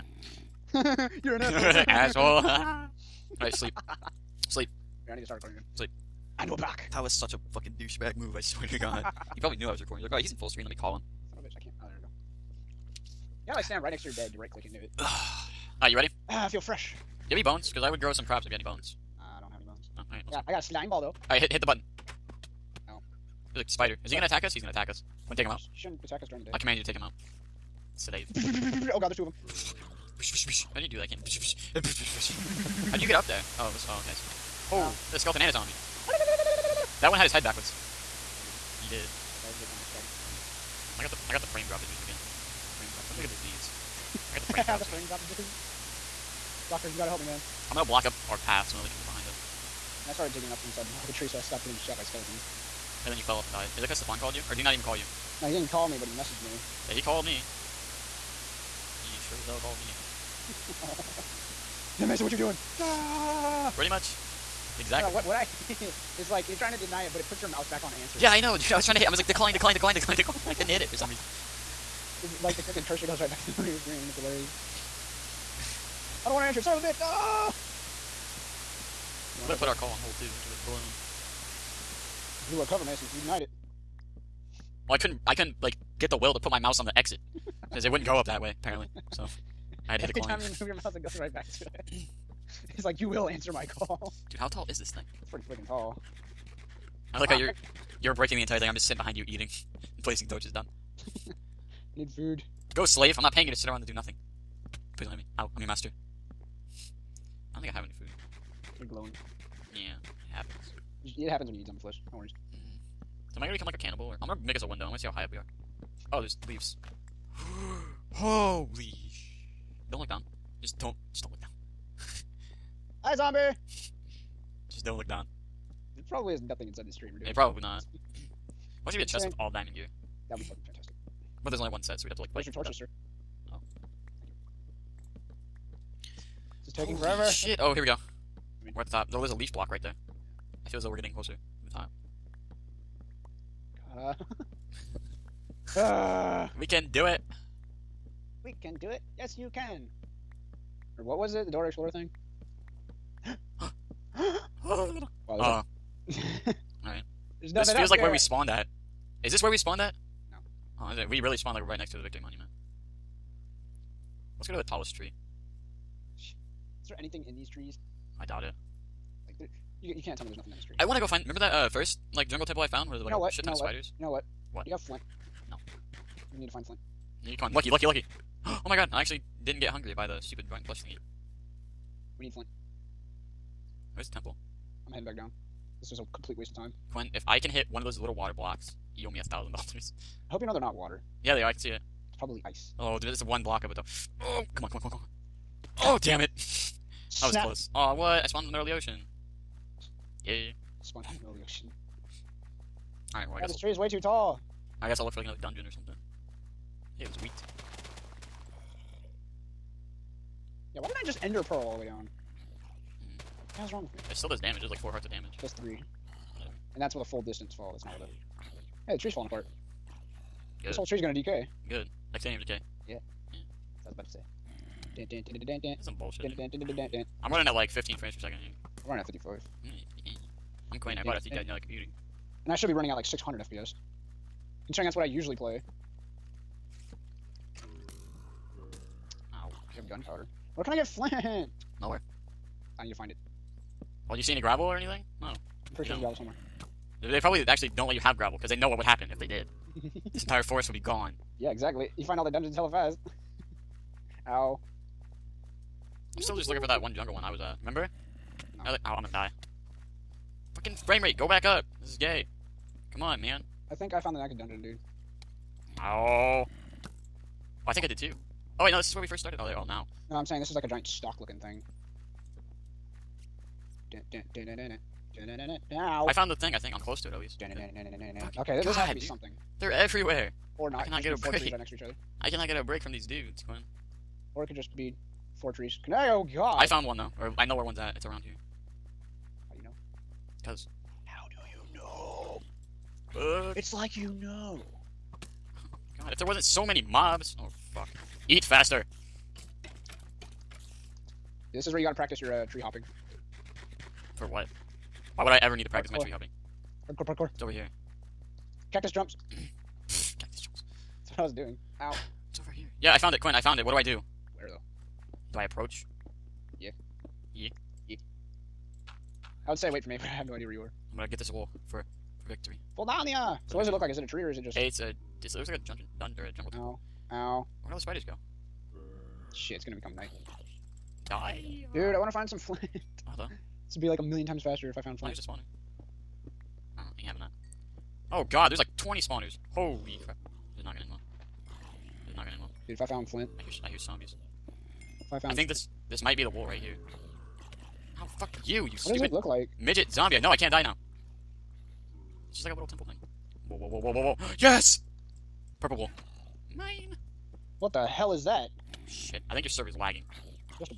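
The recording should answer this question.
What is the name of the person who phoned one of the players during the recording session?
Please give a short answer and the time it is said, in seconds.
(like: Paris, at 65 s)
Stefan, at 53 s.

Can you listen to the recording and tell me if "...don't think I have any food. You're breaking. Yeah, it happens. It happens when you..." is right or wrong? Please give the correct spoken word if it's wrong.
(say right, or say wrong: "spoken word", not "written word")
wrong: "glowing", not "breaking".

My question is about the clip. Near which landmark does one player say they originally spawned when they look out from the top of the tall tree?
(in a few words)
Victory Monument.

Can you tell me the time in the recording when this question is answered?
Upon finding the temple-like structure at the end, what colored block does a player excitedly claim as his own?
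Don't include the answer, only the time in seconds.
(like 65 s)
355 s.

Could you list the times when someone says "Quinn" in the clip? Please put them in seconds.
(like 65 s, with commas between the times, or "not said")
186 s, 230 s, 283 s, 313 s.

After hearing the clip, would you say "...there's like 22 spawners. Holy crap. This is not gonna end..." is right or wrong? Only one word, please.
wrong.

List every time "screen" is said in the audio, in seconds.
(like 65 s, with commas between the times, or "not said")
10 s, 73 s.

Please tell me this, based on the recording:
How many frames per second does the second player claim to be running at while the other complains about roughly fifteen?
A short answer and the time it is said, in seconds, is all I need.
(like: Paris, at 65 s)
54, at 229 s.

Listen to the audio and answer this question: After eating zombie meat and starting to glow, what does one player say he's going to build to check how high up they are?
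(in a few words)
A window.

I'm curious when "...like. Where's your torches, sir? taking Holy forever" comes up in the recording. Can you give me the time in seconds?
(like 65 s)
132 s.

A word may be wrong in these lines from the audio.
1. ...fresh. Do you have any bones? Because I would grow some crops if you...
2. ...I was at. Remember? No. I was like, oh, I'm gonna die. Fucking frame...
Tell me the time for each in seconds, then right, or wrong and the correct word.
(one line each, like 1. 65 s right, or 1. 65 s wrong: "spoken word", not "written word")
1. 16 s right
2. 257 s right.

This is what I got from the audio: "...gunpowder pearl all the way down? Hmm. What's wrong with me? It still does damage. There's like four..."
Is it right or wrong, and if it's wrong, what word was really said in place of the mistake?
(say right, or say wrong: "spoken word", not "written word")
wrong: "ender", not "gunpowder".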